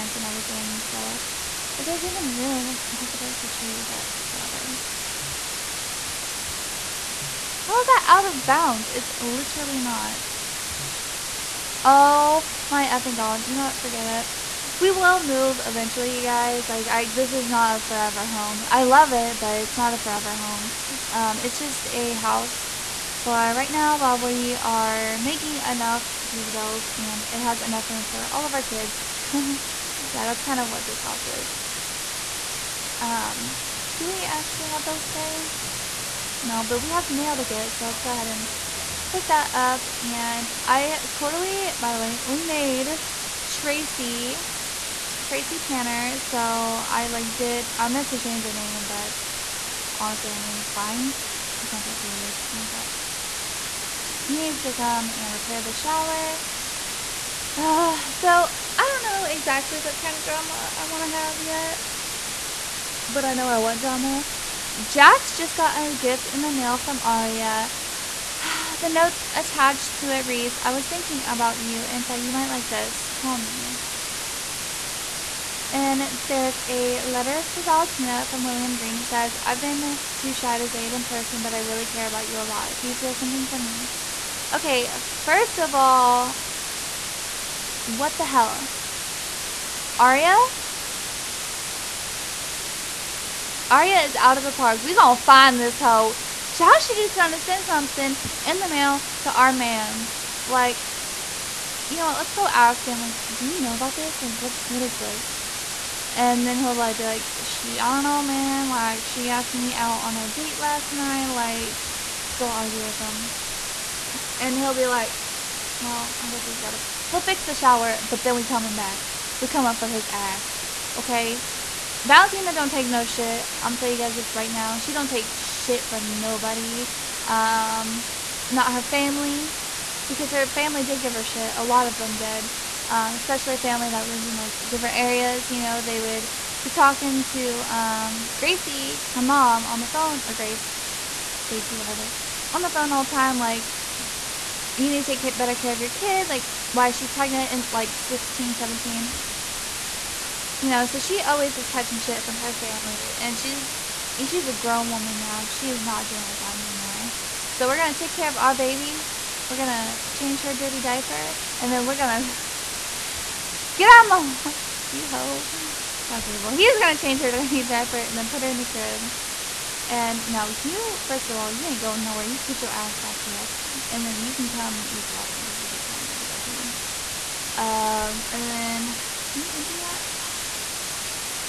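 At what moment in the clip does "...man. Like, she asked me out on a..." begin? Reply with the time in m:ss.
1:48.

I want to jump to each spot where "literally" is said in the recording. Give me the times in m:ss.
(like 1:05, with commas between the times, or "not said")
0:09.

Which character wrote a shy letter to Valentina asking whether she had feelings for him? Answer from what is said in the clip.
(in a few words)
William Green.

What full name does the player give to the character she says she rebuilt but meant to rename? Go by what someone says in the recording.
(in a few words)
Tracey Tanner.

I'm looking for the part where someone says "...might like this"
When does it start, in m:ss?
1:12.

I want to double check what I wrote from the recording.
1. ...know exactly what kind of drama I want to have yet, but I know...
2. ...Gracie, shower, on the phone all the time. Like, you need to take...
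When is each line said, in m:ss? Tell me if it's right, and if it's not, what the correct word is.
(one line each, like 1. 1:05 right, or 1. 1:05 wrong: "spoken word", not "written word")
1. 0:59 right
2. 2:21 wrong: "whatever", not "shower".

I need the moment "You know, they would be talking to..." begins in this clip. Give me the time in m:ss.
2:15.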